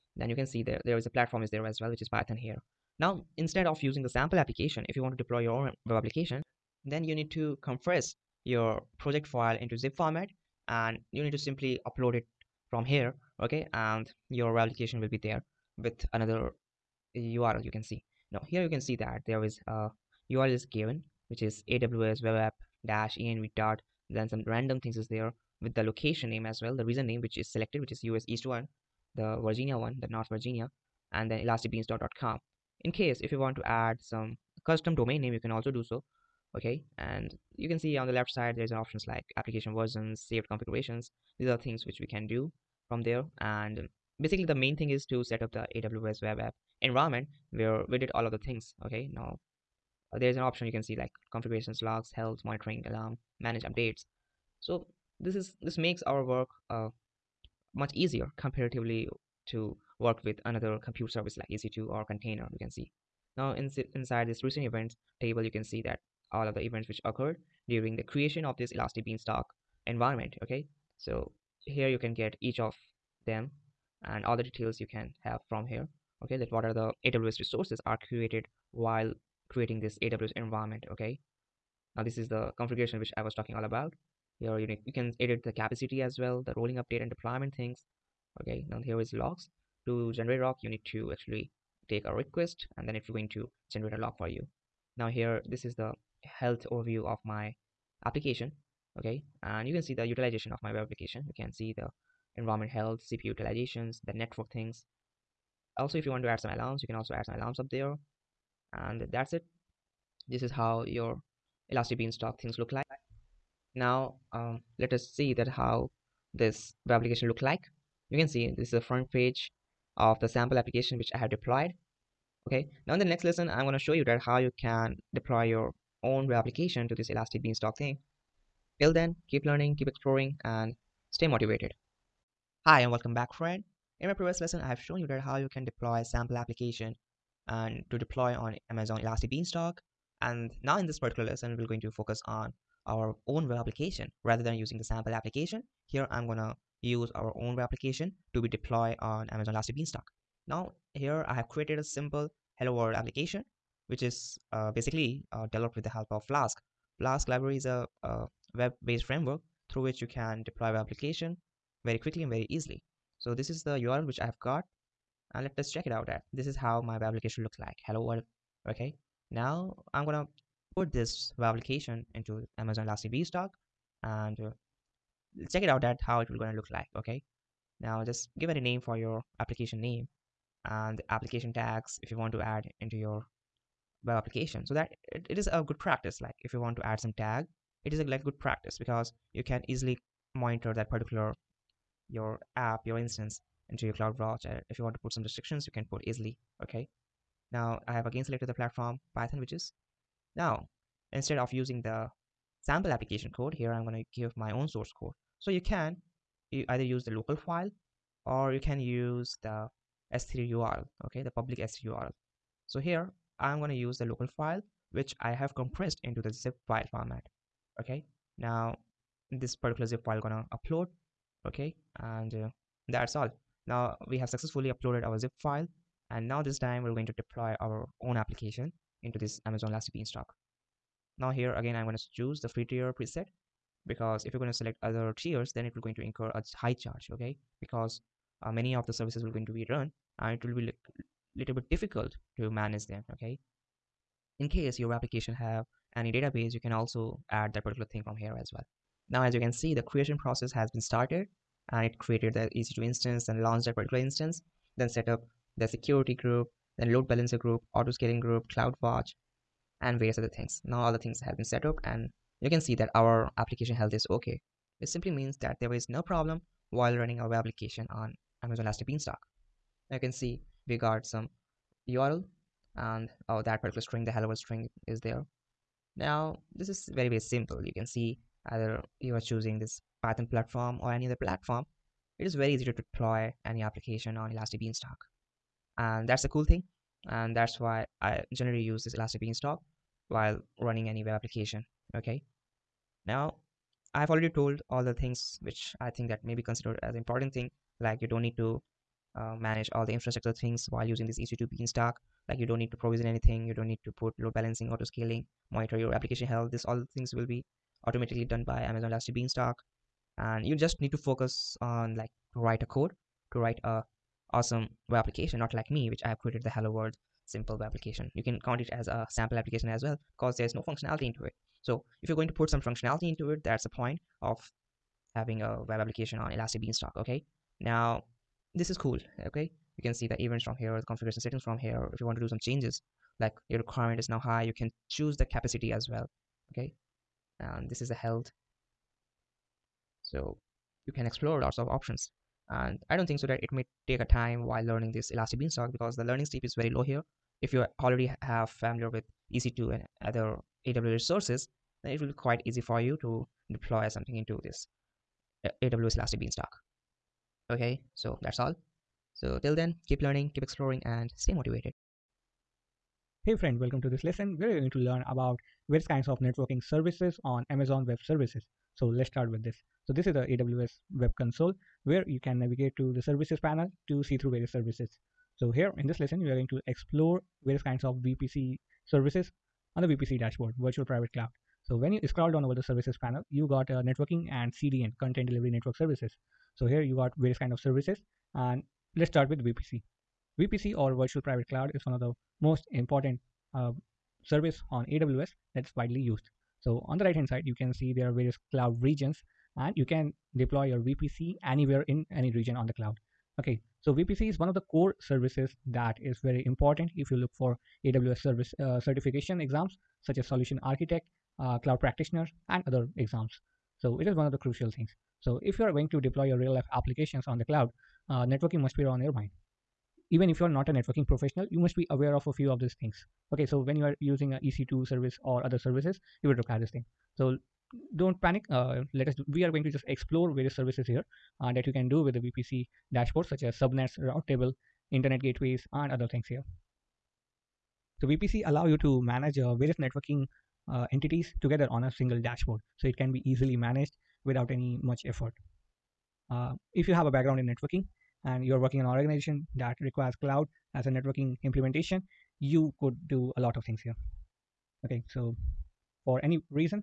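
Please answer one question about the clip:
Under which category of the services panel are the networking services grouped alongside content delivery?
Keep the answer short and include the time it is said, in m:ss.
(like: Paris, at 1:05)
networking and CDN, at 6:23.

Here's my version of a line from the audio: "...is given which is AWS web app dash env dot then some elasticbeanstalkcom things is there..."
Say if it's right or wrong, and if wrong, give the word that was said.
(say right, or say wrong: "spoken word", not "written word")
wrong: "random", not "elasticbeanstalkcom".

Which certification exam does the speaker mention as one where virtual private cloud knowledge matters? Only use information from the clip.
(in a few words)
Solution Architect.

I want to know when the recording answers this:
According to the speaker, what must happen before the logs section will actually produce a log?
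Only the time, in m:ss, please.
1:31.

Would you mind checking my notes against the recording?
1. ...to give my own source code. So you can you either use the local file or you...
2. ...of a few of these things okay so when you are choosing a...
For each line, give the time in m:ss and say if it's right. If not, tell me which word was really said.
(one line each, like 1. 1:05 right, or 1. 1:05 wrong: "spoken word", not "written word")
1. 3:23 right
2. 7:02 wrong: "using", not "choosing".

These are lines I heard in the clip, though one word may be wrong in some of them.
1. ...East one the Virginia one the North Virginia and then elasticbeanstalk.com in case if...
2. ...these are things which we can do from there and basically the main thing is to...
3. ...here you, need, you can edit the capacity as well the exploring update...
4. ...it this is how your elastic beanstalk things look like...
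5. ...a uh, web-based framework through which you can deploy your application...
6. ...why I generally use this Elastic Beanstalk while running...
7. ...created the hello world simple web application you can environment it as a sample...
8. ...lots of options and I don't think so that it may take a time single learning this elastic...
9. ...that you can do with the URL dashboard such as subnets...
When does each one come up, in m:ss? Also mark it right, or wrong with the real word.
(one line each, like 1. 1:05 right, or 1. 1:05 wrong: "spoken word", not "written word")
1. 0:28 right
2. 0:41 right
3. 1:24 wrong: "rolling", not "exploring"
4. 1:49 right
5. 2:38 right
6. 4:47 right
7. 5:16 wrong: "count", not "environment"
8. 5:41 wrong: "while", not "single"
9. 7:11 wrong: "VPC", not "URL".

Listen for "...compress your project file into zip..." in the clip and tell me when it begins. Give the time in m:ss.
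0:07.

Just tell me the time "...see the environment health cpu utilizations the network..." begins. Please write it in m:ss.
1:41.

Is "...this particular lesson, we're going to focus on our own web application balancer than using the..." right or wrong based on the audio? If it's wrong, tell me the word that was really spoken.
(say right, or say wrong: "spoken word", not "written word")
wrong: "rather", not "balancer".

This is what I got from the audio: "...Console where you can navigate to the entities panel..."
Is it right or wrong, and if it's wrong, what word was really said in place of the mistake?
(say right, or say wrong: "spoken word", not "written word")
wrong: "services", not "entities".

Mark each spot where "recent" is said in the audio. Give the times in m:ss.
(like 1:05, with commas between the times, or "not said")
1:04.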